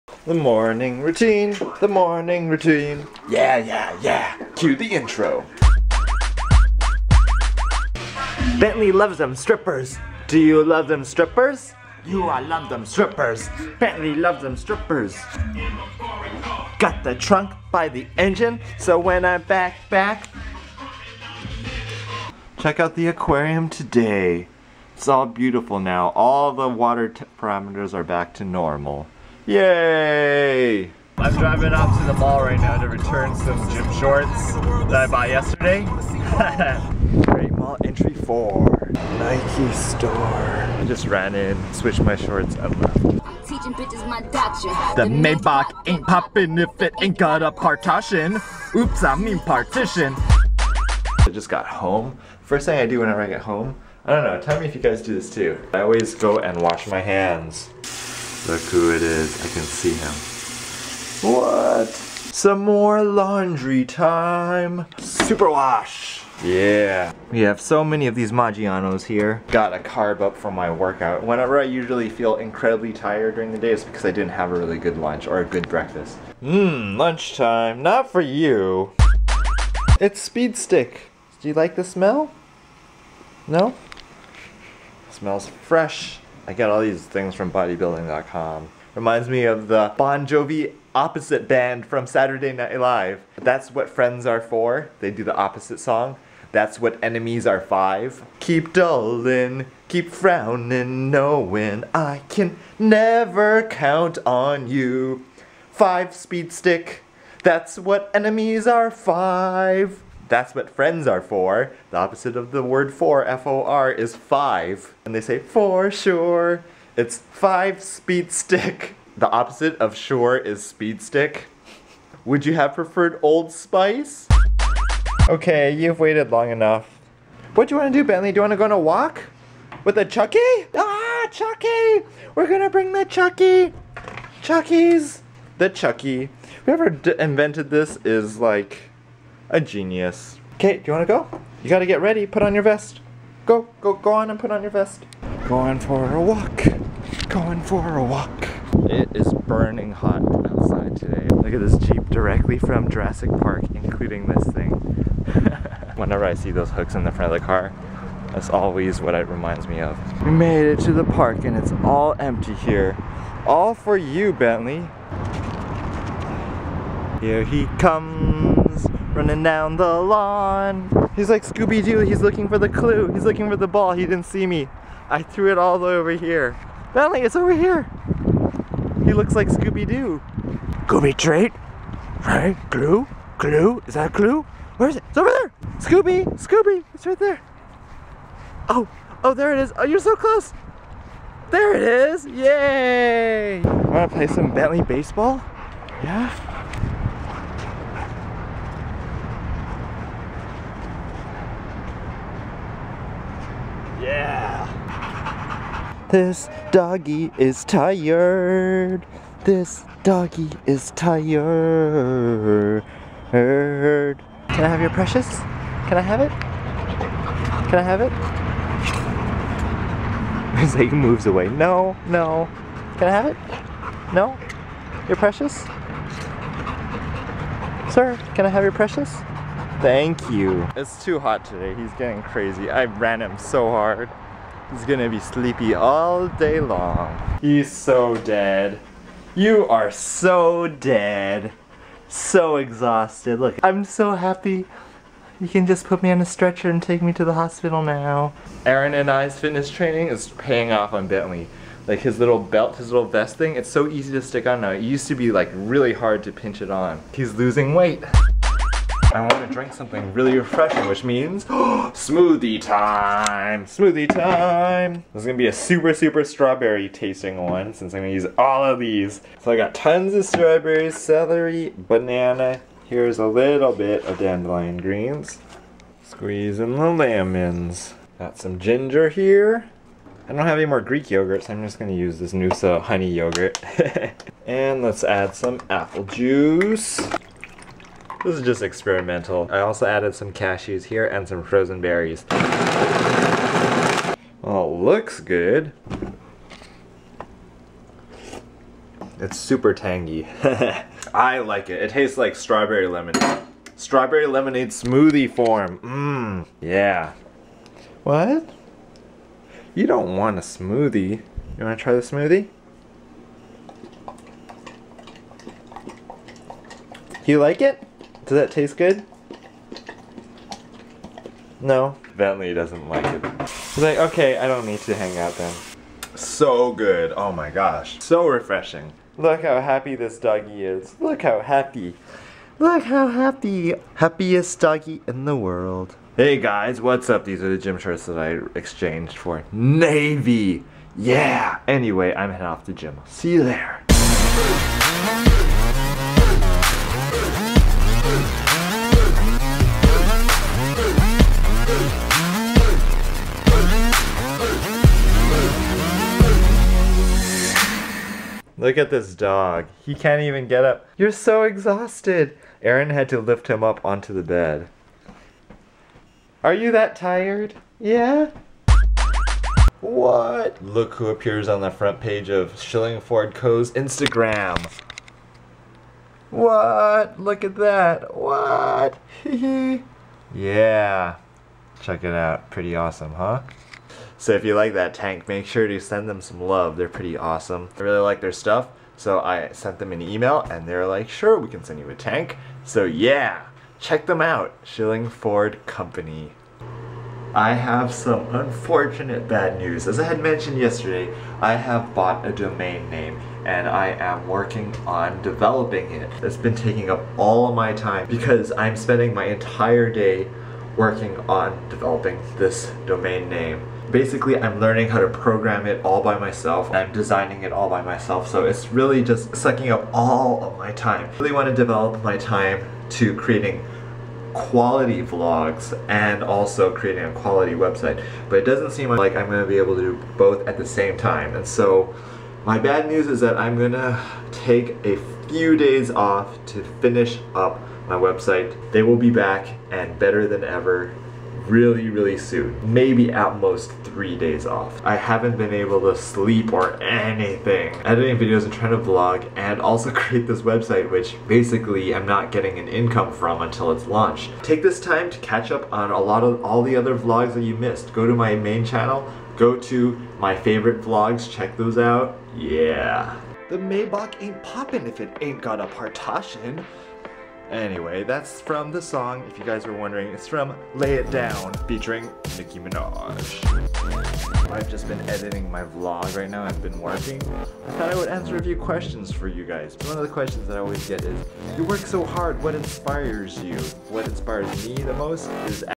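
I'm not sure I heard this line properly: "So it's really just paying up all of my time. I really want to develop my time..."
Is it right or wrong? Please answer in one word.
wrong.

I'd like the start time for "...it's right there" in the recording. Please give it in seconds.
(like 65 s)
186 s.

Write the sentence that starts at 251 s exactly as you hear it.
Like his little belt, his little vest thing, it's so easy to stick on now.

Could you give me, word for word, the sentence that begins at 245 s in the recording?
You can just put me on a stretcher and take me to the hospital now.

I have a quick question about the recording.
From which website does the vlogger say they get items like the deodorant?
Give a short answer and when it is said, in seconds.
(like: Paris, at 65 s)
bodybuilding.com, at 87 s.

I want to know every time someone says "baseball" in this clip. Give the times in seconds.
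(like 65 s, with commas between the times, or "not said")
194 s.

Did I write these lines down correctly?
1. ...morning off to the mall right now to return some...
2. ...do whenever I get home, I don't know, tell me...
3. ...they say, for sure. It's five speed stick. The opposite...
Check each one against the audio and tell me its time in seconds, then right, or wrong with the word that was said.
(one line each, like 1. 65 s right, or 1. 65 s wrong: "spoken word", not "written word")
1. 31 s wrong: "driving", not "morning"
2. 52 s right
3. 115 s right.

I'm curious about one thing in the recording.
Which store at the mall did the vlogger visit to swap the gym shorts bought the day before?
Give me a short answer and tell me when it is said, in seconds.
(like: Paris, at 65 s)
Nike, at 39 s.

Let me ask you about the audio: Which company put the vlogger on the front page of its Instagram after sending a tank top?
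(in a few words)
Shillingford Company.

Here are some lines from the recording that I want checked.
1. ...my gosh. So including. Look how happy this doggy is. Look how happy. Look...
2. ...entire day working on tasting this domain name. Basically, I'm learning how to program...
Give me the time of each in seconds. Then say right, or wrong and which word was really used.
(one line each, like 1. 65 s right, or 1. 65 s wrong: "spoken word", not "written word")
1. 327 s wrong: "refreshing", not "including"
2. 409 s wrong: "developing", not "tasting".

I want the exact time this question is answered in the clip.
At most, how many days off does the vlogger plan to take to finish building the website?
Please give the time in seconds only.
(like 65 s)
443 s.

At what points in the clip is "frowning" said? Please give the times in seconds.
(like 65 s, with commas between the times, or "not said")
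100 s.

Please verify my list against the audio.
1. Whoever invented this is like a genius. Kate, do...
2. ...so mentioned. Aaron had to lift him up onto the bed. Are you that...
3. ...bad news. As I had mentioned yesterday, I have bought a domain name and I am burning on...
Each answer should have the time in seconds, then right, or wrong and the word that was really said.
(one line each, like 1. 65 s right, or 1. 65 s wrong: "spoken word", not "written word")
1. 136 s right
2. 361 s wrong: "exhausted", not "mentioned"
3. 399 s wrong: "working", not "burning".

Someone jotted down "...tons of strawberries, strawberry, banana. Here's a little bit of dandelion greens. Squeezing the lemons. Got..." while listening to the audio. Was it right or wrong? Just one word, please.
wrong.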